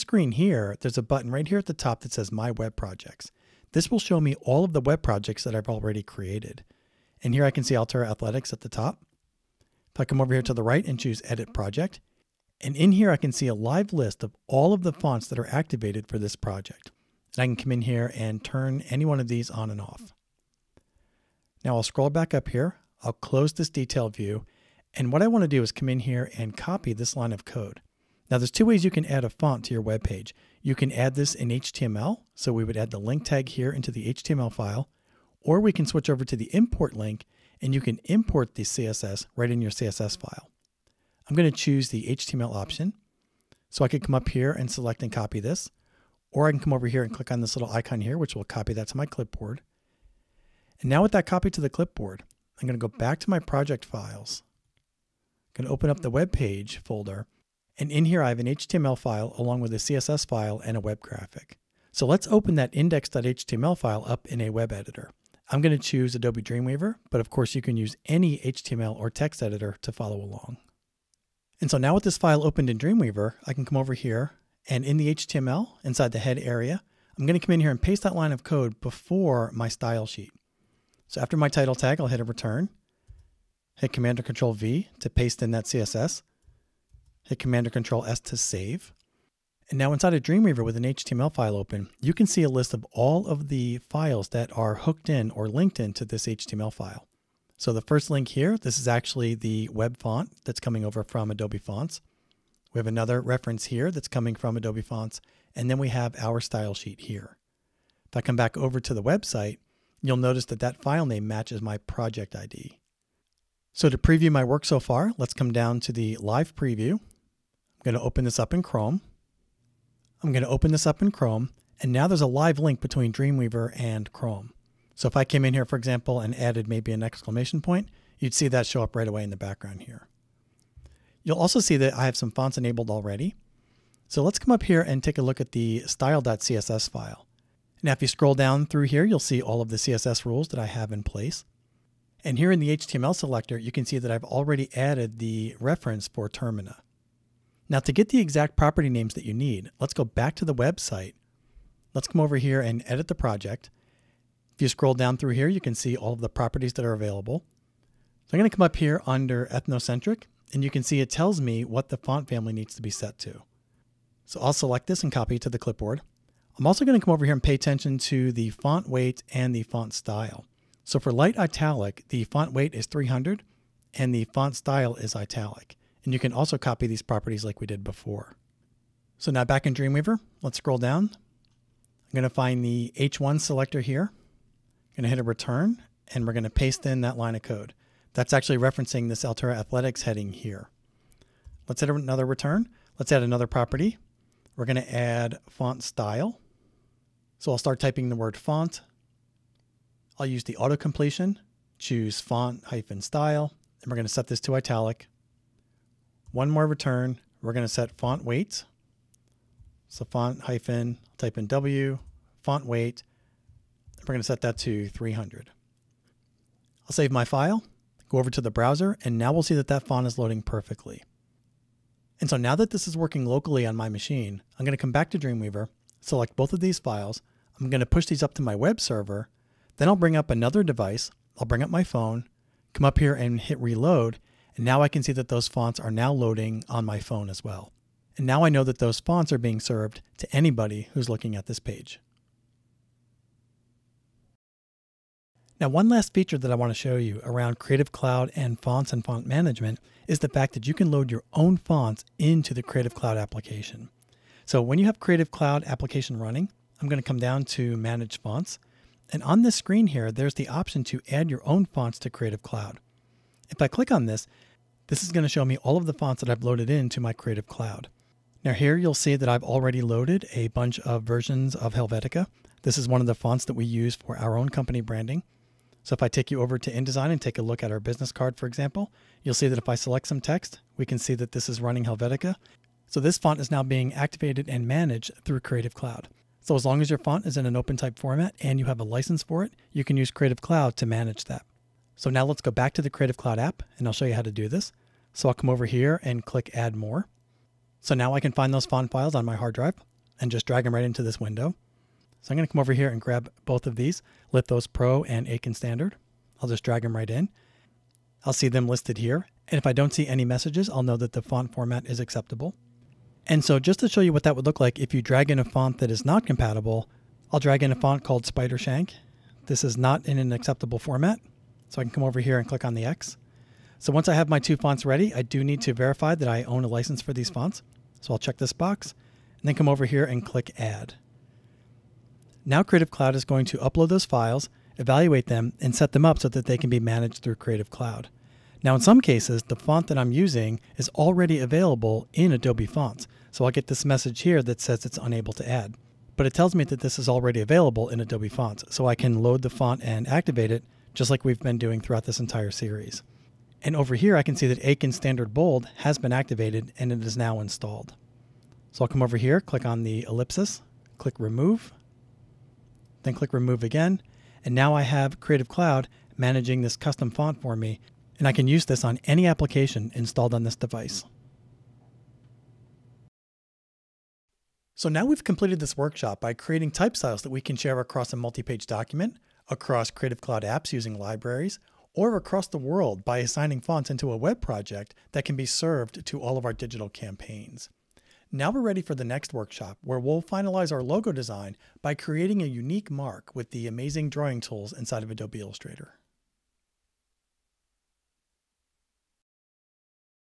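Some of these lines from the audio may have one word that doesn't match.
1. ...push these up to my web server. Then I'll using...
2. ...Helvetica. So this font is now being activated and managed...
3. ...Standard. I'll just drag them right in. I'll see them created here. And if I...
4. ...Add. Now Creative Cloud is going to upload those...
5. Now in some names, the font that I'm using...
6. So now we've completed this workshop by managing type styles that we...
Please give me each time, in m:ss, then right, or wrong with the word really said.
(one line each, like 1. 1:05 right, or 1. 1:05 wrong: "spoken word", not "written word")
1. 3:47 wrong: "bring", not "using"
2. 4:41 right
3. 5:05 wrong: "listed", not "created"
4. 5:30 right
5. 5:38 wrong: "cases", not "names"
6. 6:14 wrong: "creating", not "managing".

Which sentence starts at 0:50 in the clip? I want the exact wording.
And now with that copy to the clipboard, I'm going to go back to my project files.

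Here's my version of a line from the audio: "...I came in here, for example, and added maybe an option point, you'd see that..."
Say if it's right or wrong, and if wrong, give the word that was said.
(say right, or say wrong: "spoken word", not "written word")
wrong: "exclamation", not "option".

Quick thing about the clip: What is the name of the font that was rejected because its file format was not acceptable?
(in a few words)
Spidershank.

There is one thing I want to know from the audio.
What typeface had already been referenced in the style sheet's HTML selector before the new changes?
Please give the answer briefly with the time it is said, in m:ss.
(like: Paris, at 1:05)
Termina, at 2:26.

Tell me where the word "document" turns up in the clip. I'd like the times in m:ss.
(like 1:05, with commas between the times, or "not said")
6:18.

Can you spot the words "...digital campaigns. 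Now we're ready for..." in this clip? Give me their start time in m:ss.
6:26.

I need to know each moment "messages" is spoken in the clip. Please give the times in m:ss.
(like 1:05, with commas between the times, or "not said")
5:10, 5:43.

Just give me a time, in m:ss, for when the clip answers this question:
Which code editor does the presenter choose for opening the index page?
1:06.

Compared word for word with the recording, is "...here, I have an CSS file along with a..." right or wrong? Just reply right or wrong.
wrong.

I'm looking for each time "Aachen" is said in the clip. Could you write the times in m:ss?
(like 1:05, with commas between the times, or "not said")
5:05, 5:54.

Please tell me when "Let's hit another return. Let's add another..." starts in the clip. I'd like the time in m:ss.
3:11.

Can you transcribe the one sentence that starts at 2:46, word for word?
I'm also going to come over here and pay attention to the font weight and the font style.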